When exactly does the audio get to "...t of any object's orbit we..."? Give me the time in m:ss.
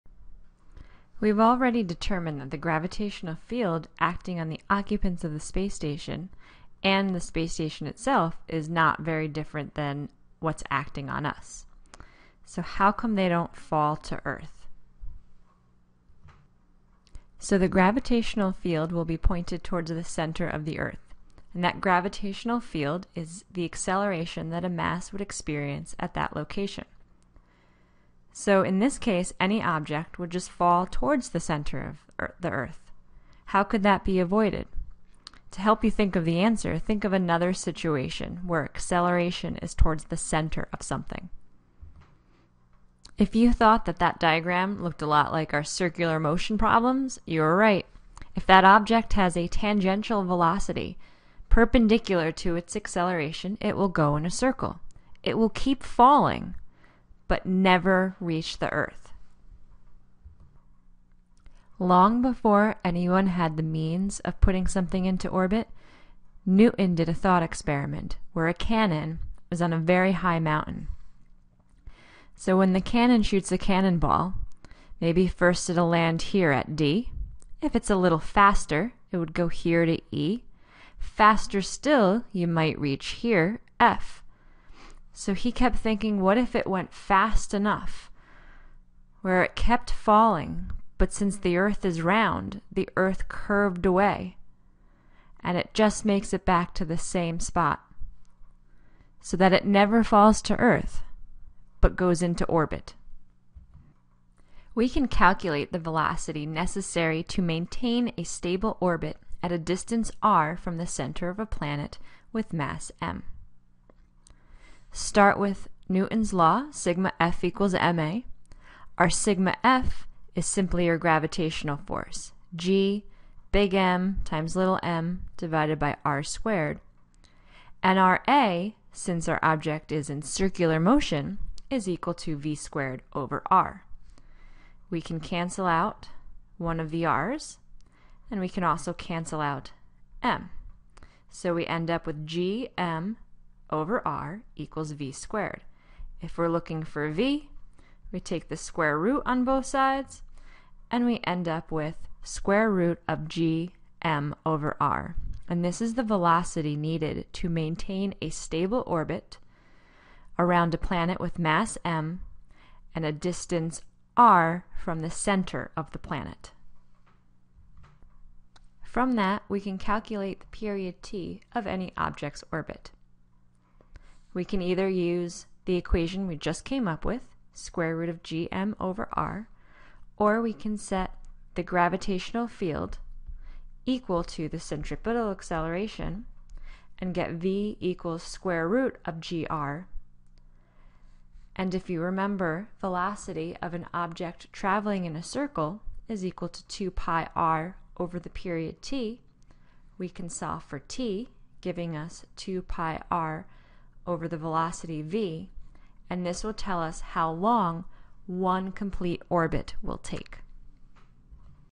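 2:51.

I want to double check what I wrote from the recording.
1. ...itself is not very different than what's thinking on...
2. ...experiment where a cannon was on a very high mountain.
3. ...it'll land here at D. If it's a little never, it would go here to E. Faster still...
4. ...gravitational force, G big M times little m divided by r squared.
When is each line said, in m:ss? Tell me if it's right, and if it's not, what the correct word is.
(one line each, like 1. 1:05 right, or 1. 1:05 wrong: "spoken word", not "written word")
1. 0:07 wrong: "acting", not "thinking"
2. 1:07 right
3. 1:15 wrong: "faster", not "never"
4. 2:00 right.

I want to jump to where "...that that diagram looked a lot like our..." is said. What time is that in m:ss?
0:43.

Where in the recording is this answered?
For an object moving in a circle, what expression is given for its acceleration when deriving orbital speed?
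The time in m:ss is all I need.
2:12.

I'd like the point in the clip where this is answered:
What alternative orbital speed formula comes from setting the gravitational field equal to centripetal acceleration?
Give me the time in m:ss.
3:08.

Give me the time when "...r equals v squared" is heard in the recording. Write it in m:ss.
2:24.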